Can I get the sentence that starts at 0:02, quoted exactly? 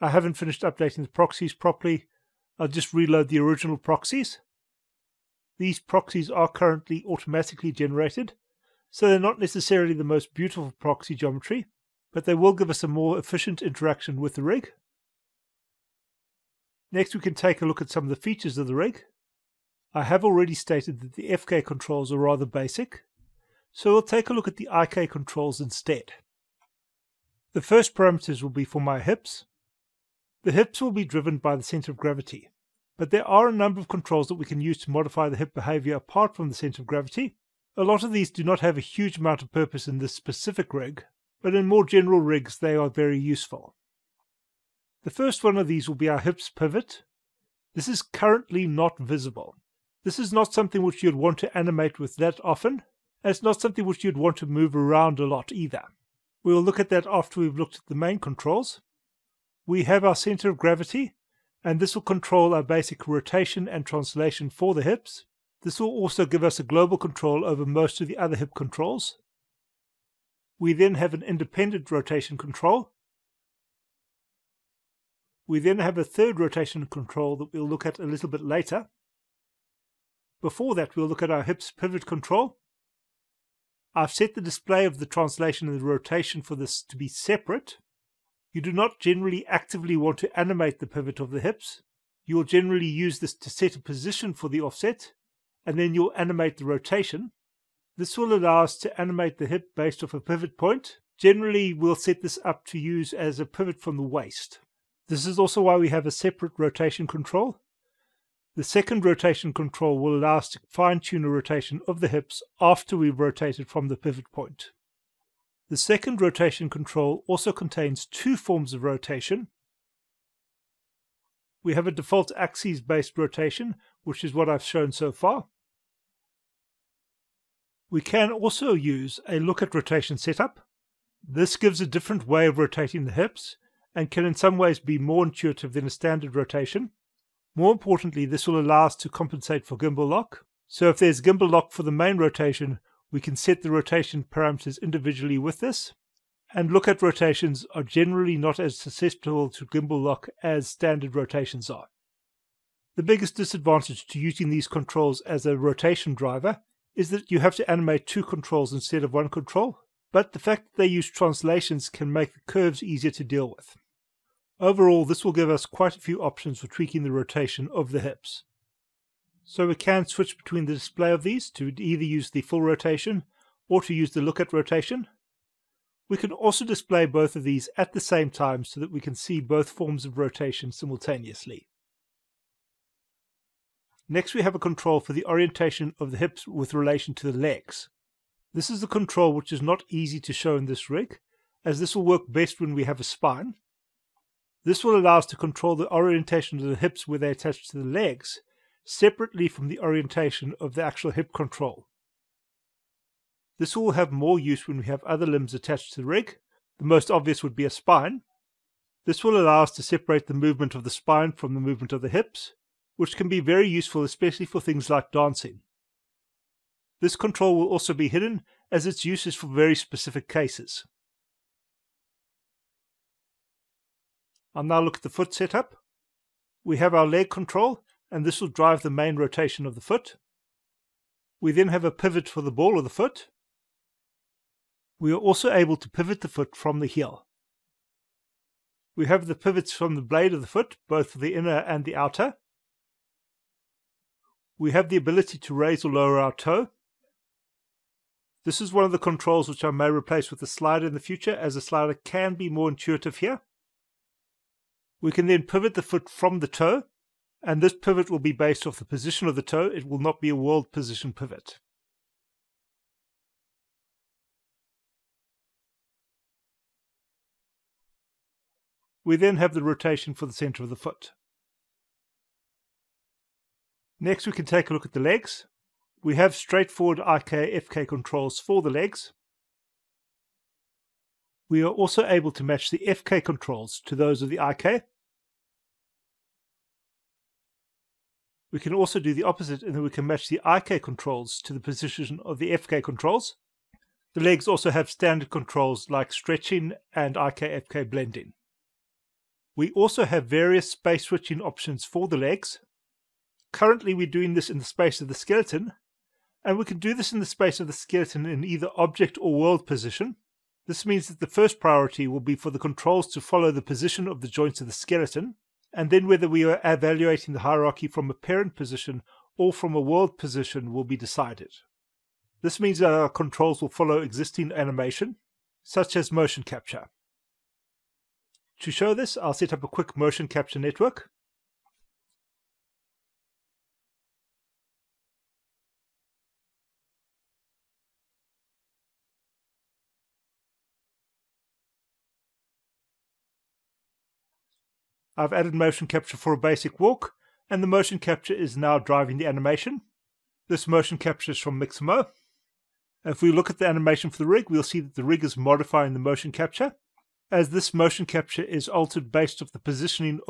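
I'll just reload the original proxies.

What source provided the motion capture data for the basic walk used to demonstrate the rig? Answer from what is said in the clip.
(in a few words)
Mixamo.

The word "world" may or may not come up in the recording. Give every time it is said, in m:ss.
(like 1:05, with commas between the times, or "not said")
4:20, 5:09, 5:19.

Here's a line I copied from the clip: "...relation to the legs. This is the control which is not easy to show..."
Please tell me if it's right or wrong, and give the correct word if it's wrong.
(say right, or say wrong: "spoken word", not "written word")
right.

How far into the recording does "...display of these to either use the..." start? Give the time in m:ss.
2:50.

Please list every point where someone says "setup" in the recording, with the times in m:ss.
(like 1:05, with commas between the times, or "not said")
2:10, 3:45.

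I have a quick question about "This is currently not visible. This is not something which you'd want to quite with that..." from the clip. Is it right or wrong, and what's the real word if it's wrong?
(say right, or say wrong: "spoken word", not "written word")
wrong: "animate", not "quite".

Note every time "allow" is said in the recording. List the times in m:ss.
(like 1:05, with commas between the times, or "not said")
1:38, 1:50, 2:18, 3:14, 3:29.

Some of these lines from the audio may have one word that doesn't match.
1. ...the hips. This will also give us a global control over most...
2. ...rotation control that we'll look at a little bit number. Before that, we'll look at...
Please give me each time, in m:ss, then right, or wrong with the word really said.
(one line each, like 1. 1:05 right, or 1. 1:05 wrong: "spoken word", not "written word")
1. 1:04 right
2. 1:16 wrong: "later", not "number".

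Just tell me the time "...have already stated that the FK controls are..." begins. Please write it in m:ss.
0:20.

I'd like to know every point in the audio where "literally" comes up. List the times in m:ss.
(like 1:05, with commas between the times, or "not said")
not said.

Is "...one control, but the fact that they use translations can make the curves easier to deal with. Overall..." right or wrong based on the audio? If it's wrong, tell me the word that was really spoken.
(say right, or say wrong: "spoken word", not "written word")
right.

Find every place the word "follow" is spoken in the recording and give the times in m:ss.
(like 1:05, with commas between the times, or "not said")
5:13, 5:23.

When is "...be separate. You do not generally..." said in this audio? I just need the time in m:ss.
1:26.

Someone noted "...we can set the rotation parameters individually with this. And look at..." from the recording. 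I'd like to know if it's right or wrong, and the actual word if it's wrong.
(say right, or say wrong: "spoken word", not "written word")
right.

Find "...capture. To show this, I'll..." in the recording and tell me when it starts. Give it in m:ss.
5:26.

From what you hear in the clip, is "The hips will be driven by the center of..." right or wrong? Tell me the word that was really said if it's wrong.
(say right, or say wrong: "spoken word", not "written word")
right.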